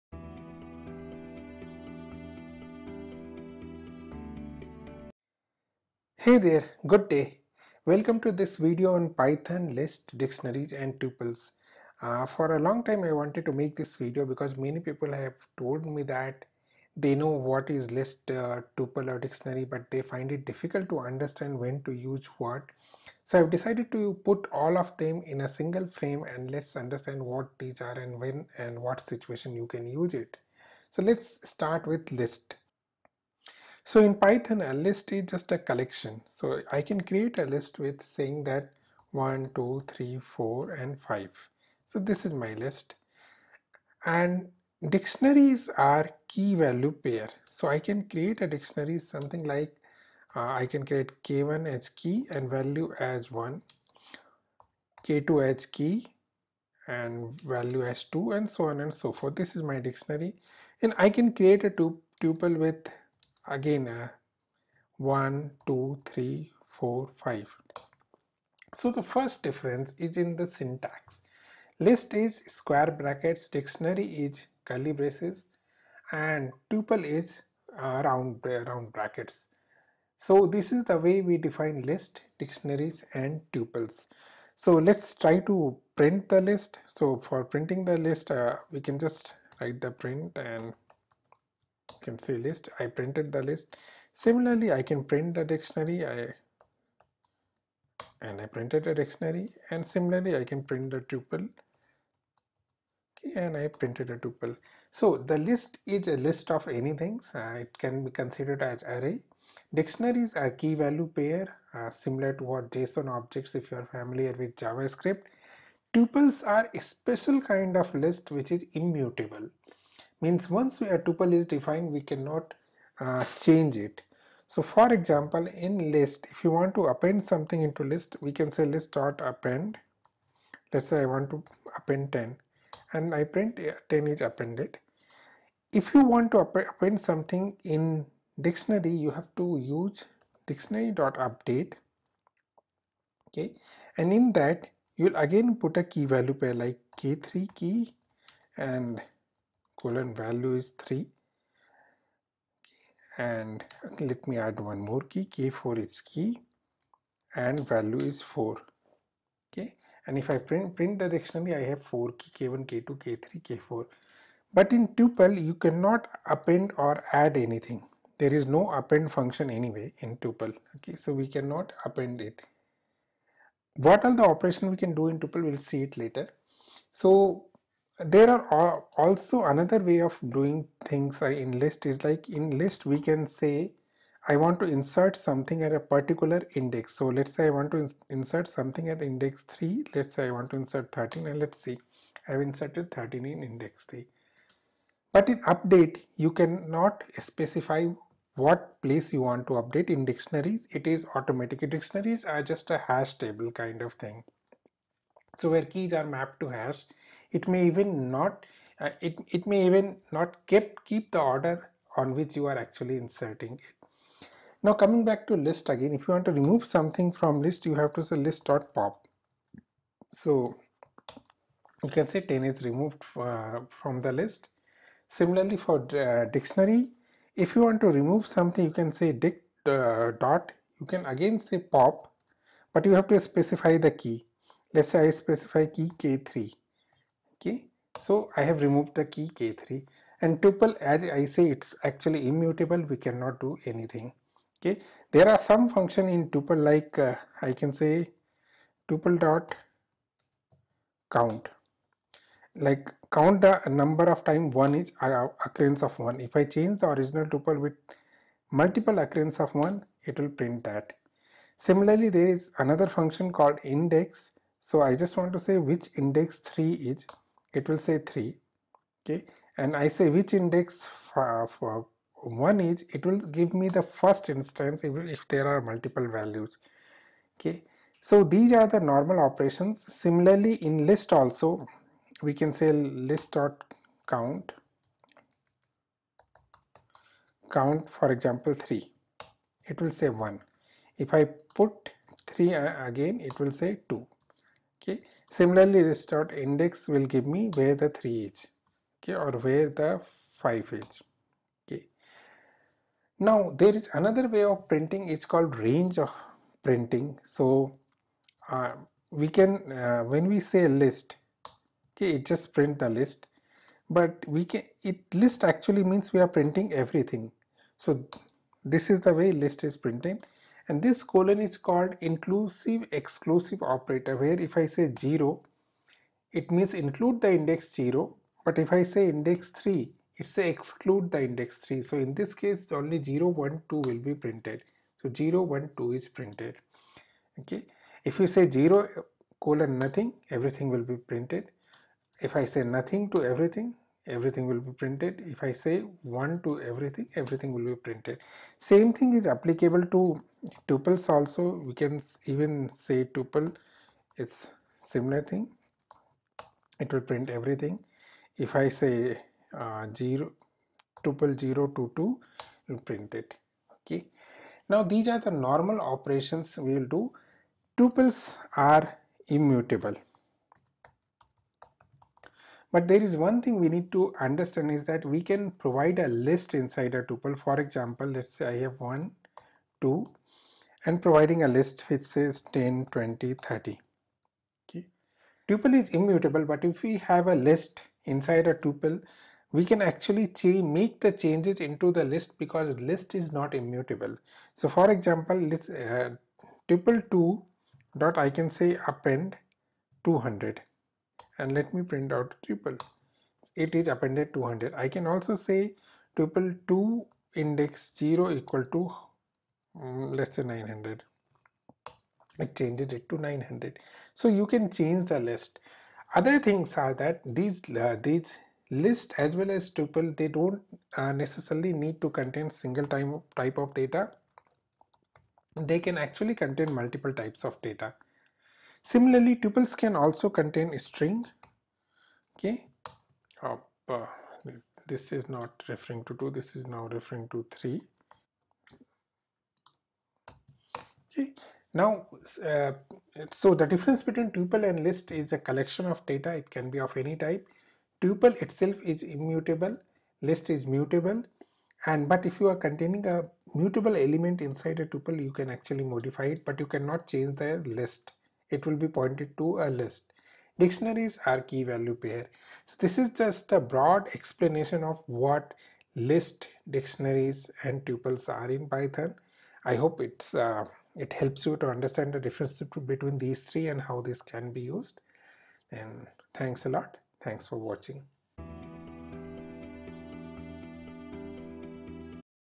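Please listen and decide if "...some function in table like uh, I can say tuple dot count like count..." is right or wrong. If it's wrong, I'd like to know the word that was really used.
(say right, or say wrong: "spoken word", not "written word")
wrong: "tuple", not "table".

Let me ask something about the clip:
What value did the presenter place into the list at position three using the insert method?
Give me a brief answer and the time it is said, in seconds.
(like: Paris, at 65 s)
13, at 190 s.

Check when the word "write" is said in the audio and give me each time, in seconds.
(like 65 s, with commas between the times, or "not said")
89 s.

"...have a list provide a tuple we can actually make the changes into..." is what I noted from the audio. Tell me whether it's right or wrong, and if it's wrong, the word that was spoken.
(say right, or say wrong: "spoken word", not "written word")
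wrong: "inside", not "provide".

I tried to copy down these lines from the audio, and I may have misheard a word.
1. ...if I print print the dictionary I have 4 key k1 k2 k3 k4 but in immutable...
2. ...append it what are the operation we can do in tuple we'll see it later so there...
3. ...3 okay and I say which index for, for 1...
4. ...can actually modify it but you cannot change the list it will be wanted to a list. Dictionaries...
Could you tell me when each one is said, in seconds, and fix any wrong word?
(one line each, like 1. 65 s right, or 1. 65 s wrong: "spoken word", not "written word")
1. 160 s wrong: "tuple", not "immutable"
2. 171 s right
3. 267 s right
4. 455 s wrong: "pointed", not "wanted".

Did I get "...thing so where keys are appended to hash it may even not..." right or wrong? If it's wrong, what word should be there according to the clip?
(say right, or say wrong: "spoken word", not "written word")
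wrong: "mapped", not "appended".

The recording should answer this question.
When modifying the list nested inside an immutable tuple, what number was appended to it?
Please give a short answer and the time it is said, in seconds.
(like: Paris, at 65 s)
200, at 398 s.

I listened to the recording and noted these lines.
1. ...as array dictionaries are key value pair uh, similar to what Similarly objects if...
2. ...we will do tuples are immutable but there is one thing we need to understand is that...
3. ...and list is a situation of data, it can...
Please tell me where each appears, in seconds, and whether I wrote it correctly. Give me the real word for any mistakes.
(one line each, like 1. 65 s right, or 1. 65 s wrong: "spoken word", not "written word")
1. 108 s wrong: "JSON", not "Similarly"
2. 366 s right
3. 444 s wrong: "collection", not "situation".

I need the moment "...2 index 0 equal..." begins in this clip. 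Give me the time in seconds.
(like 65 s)
406 s.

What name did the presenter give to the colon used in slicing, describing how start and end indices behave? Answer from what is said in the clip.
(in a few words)
inclusive exclusive operator.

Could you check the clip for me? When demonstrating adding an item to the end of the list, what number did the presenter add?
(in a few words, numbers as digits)
10.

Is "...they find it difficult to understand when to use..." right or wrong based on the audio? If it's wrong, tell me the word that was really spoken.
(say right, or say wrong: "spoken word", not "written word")
right.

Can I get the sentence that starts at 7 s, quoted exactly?
Welcome to this video on Python list dictionaries and tuples.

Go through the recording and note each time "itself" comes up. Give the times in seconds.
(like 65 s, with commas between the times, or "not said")
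448 s.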